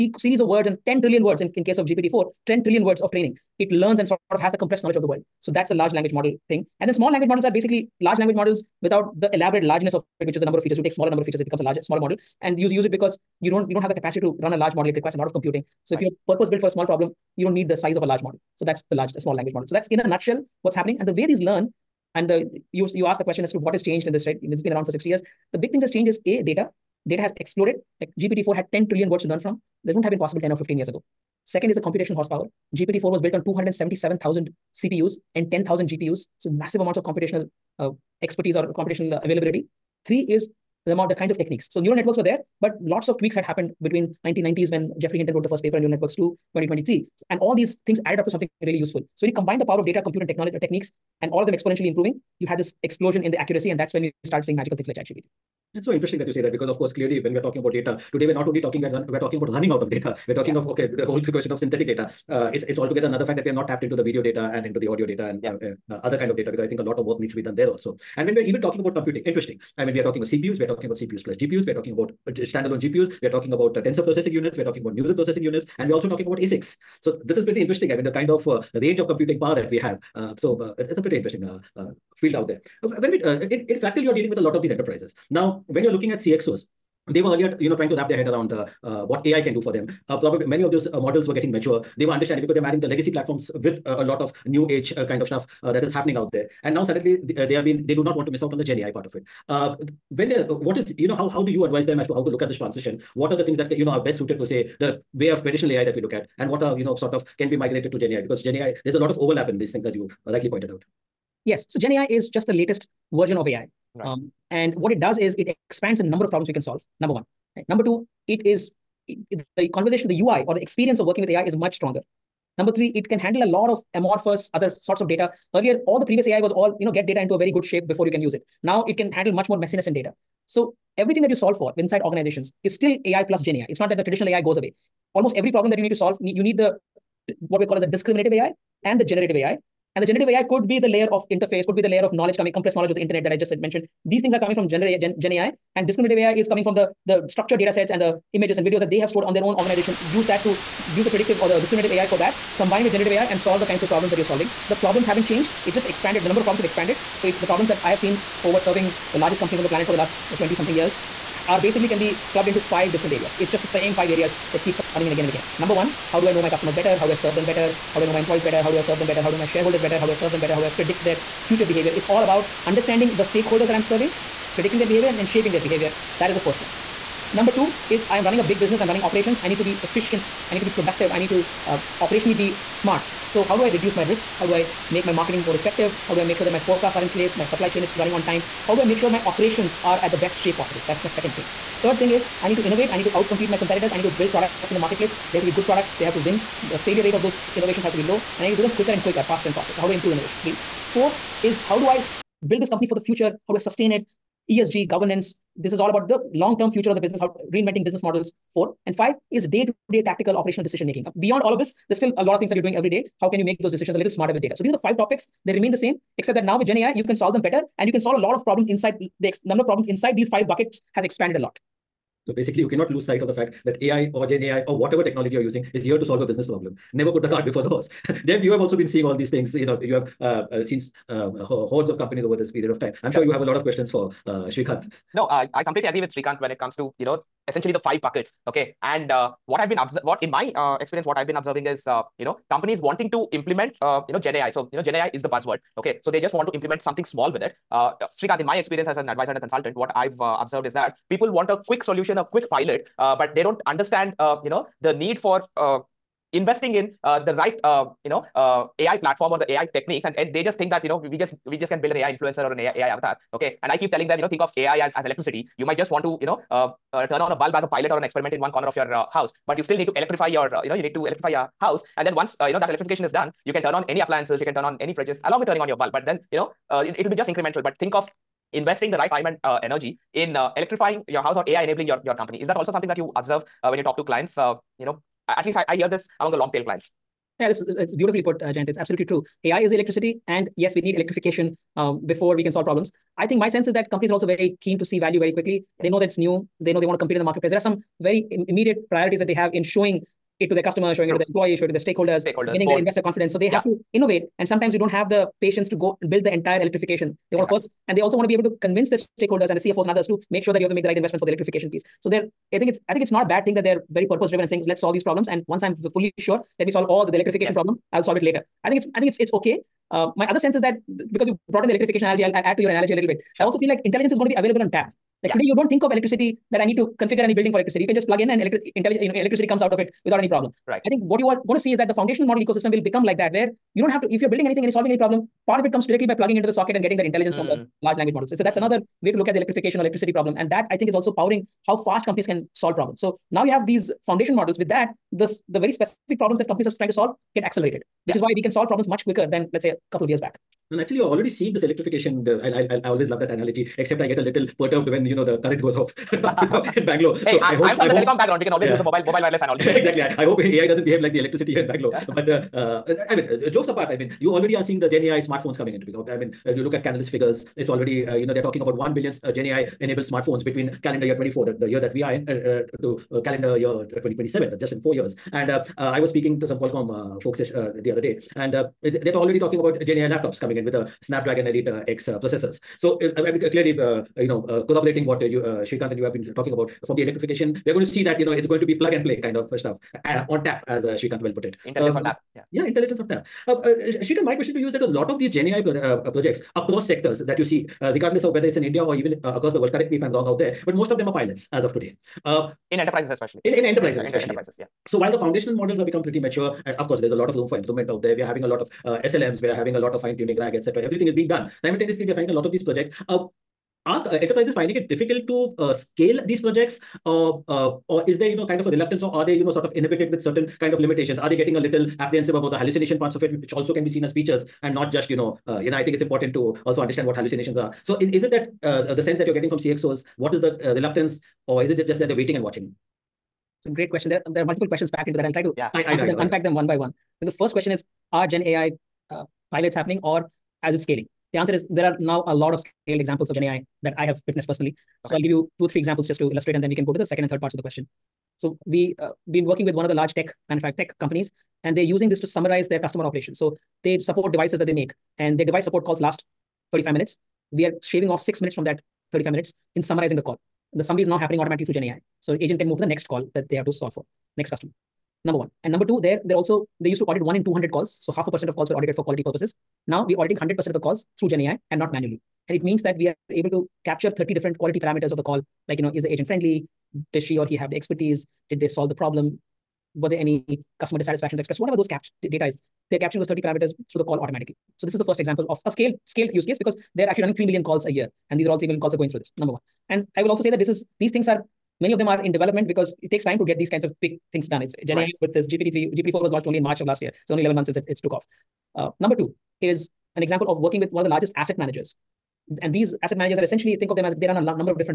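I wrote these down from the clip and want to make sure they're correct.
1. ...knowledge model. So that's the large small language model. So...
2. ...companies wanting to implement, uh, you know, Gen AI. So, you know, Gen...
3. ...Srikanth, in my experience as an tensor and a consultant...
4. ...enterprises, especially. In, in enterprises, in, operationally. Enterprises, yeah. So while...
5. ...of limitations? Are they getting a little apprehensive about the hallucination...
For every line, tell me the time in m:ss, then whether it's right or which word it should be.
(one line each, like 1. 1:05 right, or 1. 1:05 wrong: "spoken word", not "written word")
1. 0:18 wrong: "large", not "knowledge"
2. 4:02 right
3. 4:08 wrong: "advisor", not "tensor"
4. 6:42 wrong: "especially", not "operationally"
5. 7:00 right.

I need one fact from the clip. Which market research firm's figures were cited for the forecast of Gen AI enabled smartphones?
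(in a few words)
Canalys.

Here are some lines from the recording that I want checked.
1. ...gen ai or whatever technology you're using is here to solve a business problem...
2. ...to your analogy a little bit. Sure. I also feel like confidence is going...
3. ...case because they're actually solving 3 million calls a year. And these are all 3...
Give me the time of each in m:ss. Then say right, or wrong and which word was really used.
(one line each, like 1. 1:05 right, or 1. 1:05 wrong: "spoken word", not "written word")
1. 3:44 right
2. 5:22 wrong: "intelligence", not "confidence"
3. 8:06 wrong: "running", not "solving".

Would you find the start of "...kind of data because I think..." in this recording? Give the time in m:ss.
1:06.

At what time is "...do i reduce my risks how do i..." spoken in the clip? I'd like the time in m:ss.
3:03.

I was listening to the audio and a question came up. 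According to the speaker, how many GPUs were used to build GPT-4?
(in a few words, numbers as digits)
10000.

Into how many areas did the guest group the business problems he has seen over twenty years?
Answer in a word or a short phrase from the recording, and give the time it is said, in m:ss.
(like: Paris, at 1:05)
5, at 2:42.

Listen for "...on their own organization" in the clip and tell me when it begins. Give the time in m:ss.
2:29.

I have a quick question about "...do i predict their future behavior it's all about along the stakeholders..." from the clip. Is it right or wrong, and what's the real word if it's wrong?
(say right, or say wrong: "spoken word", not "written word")
wrong: "understanding", not "along".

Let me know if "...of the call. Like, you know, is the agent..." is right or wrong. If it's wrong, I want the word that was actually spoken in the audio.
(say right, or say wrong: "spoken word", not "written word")
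right.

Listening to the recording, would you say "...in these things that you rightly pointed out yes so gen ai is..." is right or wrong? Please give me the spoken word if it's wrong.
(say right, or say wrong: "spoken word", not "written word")
right.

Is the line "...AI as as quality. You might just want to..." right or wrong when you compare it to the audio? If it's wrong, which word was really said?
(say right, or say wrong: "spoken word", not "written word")
wrong: "electricity", not "quality".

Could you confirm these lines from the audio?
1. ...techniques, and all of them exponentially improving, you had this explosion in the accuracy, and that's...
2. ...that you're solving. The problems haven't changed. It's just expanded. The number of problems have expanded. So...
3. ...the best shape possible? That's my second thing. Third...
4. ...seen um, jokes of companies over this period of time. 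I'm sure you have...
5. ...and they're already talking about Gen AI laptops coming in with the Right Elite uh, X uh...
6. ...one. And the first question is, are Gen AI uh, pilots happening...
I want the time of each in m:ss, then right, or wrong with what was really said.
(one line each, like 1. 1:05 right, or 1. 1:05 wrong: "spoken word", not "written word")
1. 0:50 right
2. 2:34 right
3. 3:10 right
4. 3:50 wrong: "hordes", not "jokes"
5. 6:18 wrong: "Snapdragon", not "Right"
6. 7:16 right.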